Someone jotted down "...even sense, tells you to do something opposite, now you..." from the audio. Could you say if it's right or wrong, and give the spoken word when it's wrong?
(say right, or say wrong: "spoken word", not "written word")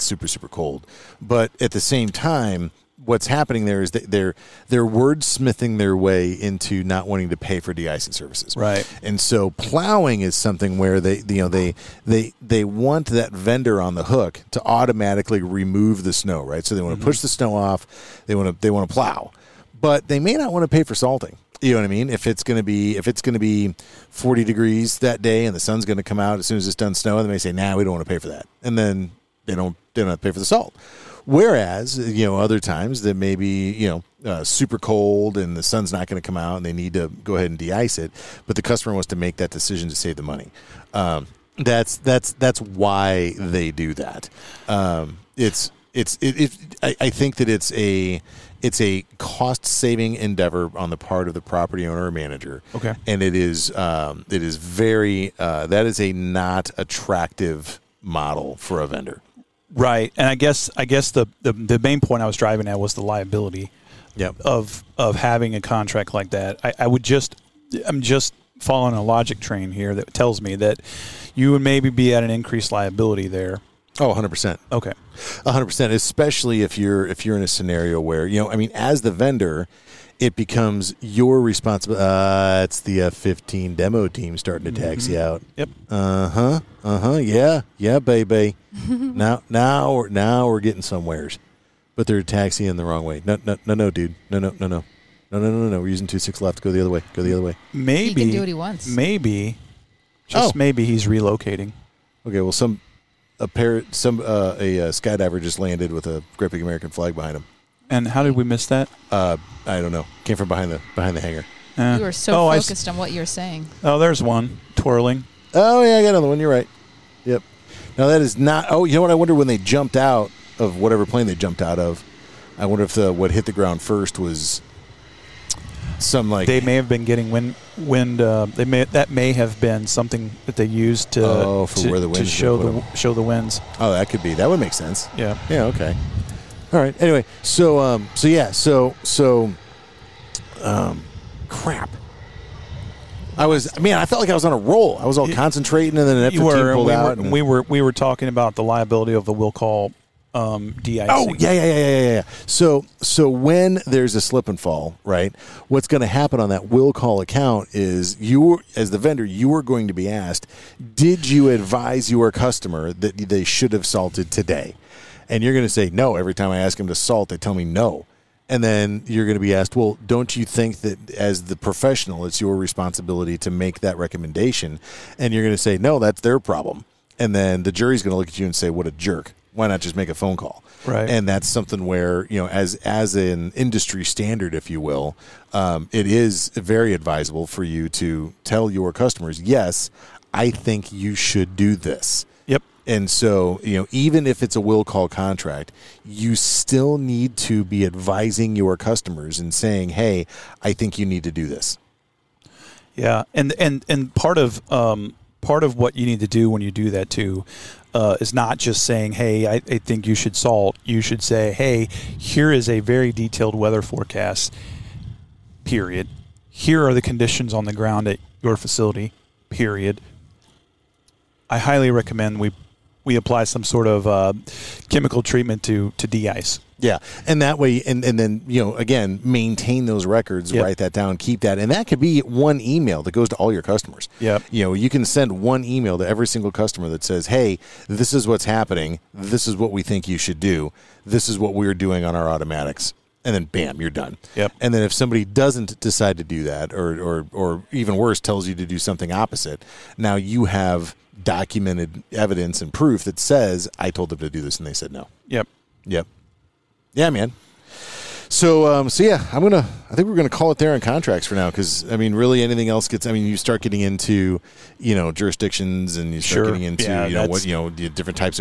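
wrong: "worse", not "sense".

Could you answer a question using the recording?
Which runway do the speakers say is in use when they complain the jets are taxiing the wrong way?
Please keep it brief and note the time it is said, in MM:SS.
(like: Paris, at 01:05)
26 left, at 01:36.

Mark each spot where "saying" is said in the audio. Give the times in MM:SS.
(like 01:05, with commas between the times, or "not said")
01:53, 03:19, 03:28.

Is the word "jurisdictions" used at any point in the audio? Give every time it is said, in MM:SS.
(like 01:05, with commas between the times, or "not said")
04:25.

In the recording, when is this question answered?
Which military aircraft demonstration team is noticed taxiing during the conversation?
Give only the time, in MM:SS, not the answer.
01:23.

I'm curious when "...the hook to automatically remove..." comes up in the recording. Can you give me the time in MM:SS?
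00:13.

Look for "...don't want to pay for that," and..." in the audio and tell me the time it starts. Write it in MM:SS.
00:27.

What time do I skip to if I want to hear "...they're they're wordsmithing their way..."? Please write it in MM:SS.
00:04.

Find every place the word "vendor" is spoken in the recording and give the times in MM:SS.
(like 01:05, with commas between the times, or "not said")
00:13, 00:58, 01:19, 02:38.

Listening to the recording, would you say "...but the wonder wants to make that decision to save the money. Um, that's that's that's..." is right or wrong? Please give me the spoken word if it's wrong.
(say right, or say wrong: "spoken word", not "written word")
wrong: "customer", not "wonder".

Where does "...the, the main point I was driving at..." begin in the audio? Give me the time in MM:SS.
01:01.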